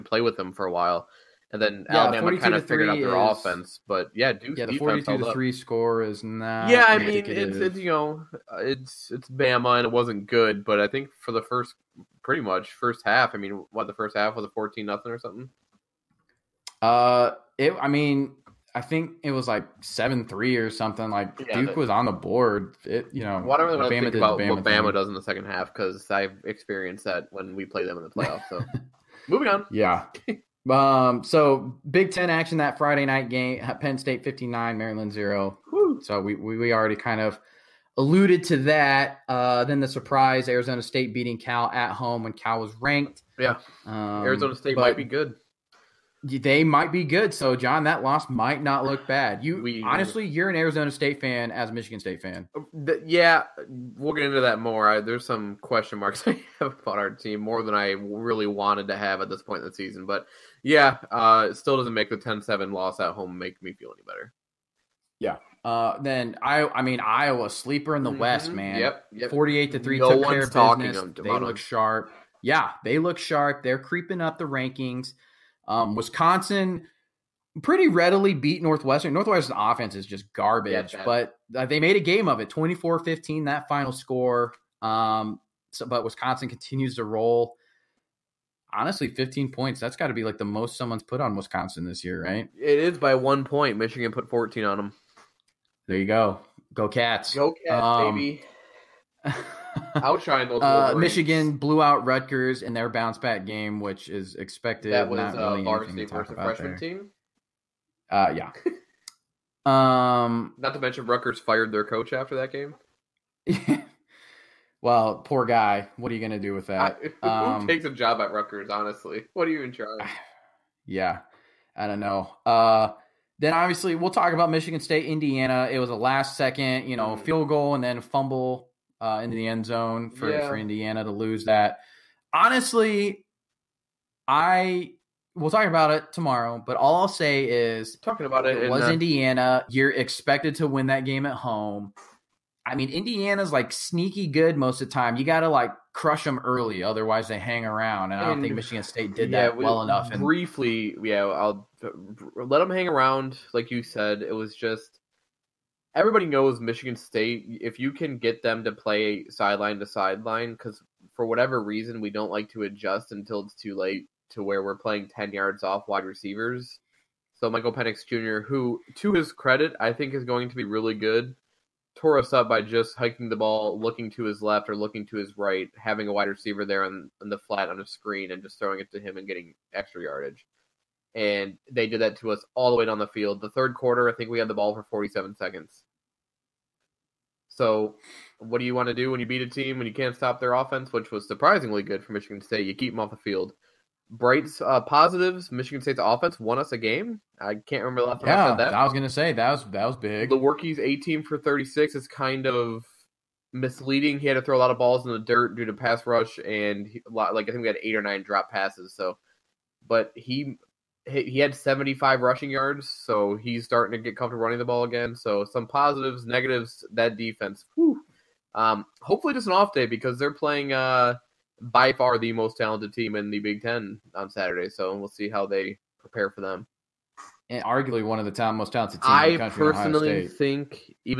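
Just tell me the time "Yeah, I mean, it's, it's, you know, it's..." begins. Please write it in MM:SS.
00:06.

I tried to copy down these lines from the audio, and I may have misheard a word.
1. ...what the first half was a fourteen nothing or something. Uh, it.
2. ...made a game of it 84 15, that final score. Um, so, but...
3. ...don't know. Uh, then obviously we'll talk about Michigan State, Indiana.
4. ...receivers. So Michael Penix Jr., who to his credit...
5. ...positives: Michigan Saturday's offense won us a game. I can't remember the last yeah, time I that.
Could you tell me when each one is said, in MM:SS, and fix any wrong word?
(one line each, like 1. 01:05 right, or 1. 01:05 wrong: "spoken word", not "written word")
1. 00:13 right
2. 01:21 wrong: "24", not "84"
3. 02:01 right
4. 02:46 right
5. 03:14 wrong: "State", not "Saturday".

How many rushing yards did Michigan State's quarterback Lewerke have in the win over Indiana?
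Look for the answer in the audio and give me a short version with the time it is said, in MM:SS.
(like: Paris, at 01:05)
75, at 03:31.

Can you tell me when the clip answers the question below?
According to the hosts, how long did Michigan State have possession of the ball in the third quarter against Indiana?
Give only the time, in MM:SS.
03:04.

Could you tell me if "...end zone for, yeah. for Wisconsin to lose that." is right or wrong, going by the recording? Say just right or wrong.
wrong.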